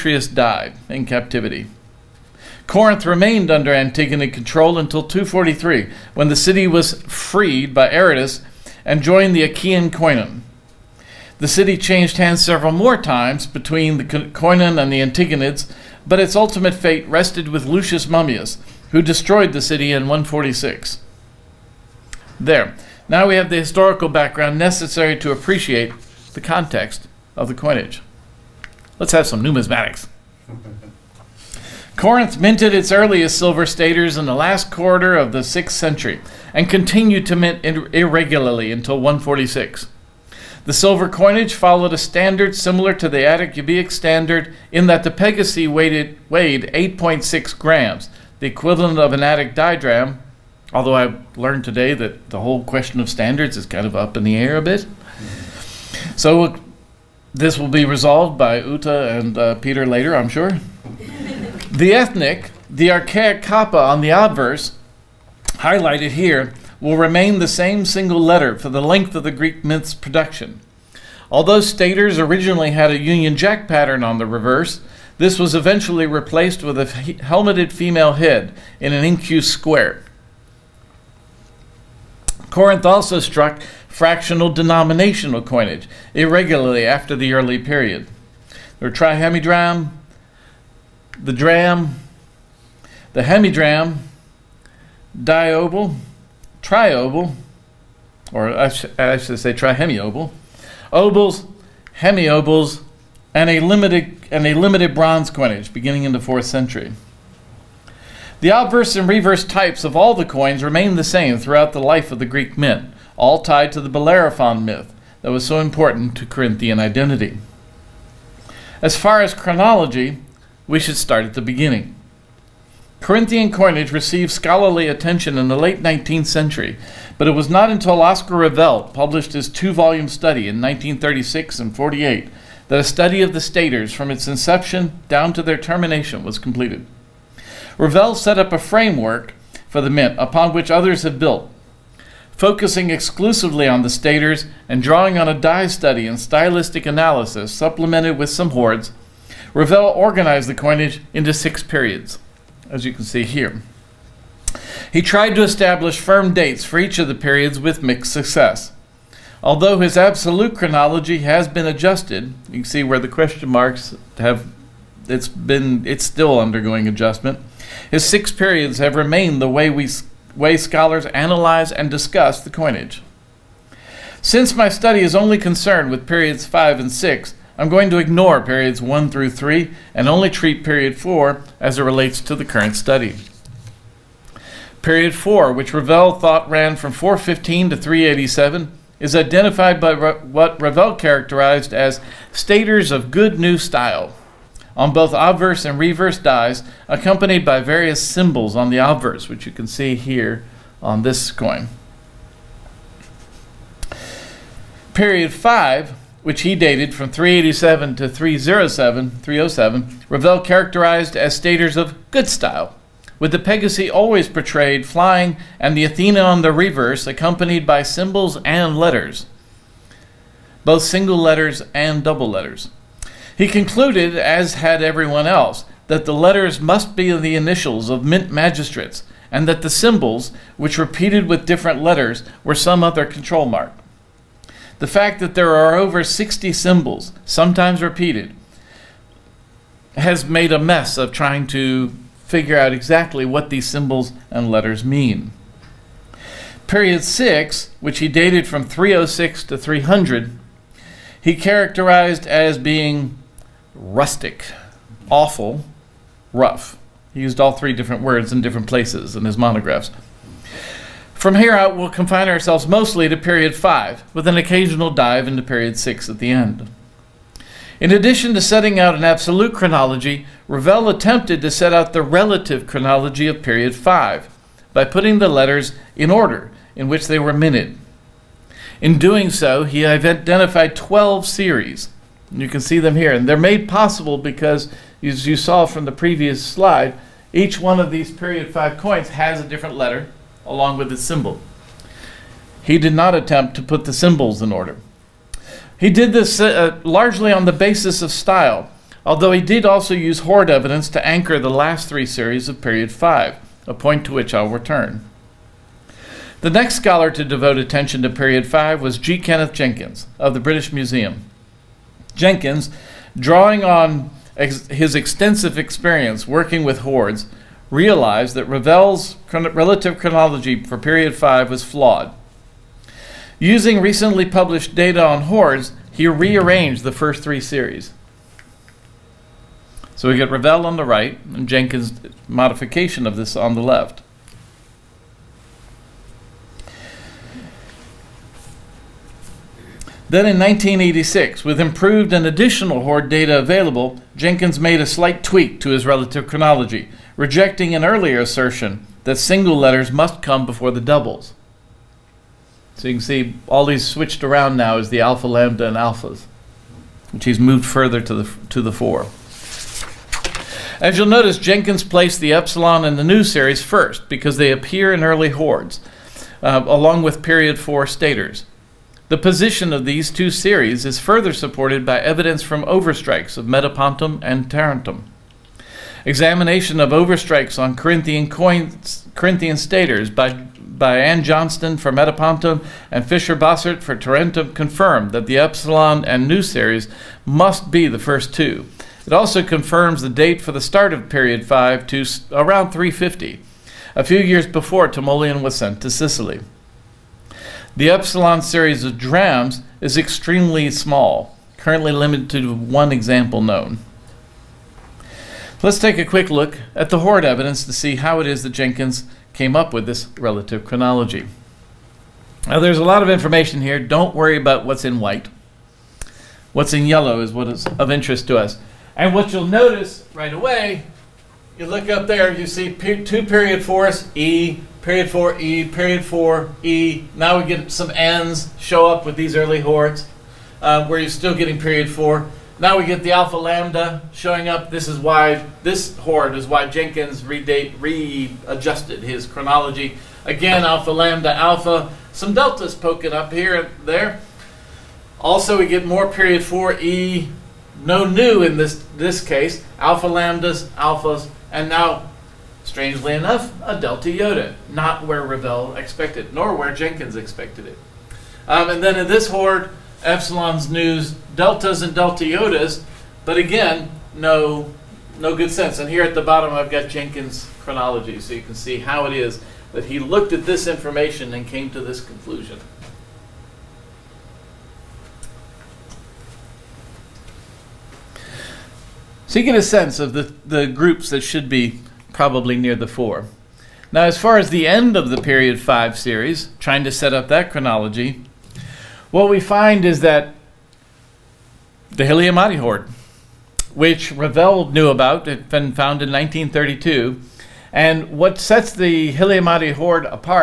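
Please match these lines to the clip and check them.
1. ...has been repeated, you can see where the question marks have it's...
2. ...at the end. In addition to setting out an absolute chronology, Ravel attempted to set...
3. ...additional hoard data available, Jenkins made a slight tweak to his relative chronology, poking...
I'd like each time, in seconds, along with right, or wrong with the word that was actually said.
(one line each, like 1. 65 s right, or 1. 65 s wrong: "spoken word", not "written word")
1. 161 s wrong: "adjusted", not "repeated"
2. 266 s right
3. 342 s wrong: "rejecting", not "poking".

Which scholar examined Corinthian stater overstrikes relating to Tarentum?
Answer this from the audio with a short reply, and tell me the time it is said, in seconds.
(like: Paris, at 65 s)
Fischer-Bossert, at 383 s.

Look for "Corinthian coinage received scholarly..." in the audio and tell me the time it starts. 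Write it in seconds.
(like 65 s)
122 s.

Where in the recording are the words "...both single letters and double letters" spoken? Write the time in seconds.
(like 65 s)
220 s.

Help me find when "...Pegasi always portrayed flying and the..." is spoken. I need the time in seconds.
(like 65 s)
213 s.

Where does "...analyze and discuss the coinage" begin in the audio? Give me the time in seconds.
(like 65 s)
171 s.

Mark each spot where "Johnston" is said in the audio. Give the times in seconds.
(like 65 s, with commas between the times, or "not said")
381 s.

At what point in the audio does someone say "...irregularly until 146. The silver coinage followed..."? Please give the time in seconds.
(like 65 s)
37 s.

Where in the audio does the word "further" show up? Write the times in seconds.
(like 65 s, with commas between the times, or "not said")
357 s, 370 s.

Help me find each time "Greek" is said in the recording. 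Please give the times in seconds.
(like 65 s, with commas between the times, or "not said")
69 s, 112 s.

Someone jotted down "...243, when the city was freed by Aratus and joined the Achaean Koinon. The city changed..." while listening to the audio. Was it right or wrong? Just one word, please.
right.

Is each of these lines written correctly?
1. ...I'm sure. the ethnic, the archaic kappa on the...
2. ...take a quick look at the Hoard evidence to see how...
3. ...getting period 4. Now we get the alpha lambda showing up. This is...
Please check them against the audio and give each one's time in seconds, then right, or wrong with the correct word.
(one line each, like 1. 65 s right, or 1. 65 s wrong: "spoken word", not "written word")
1. 60 s right
2. 405 s right
3. 431 s right.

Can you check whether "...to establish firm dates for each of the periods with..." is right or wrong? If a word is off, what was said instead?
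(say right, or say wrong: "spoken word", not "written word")
right.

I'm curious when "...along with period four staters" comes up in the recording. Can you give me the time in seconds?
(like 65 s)
366 s.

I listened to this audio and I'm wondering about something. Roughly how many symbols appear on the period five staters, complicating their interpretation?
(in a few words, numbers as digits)
over 60.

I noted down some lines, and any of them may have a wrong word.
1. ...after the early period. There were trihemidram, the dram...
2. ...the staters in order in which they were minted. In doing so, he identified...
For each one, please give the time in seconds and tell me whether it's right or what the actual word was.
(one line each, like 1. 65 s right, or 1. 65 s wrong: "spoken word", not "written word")
1. 86 s right
2. 275 s wrong: "letters", not "staters".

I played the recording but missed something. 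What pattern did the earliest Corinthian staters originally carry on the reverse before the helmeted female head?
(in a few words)
Union Jack pattern.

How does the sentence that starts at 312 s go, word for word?
Jenkins, drawing on ex- his extensive experience working with hoards, realized that Ravel's chron- relative chronology for period 5 was flawed.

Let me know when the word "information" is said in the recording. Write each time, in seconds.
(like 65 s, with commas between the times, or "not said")
413 s, 470 s.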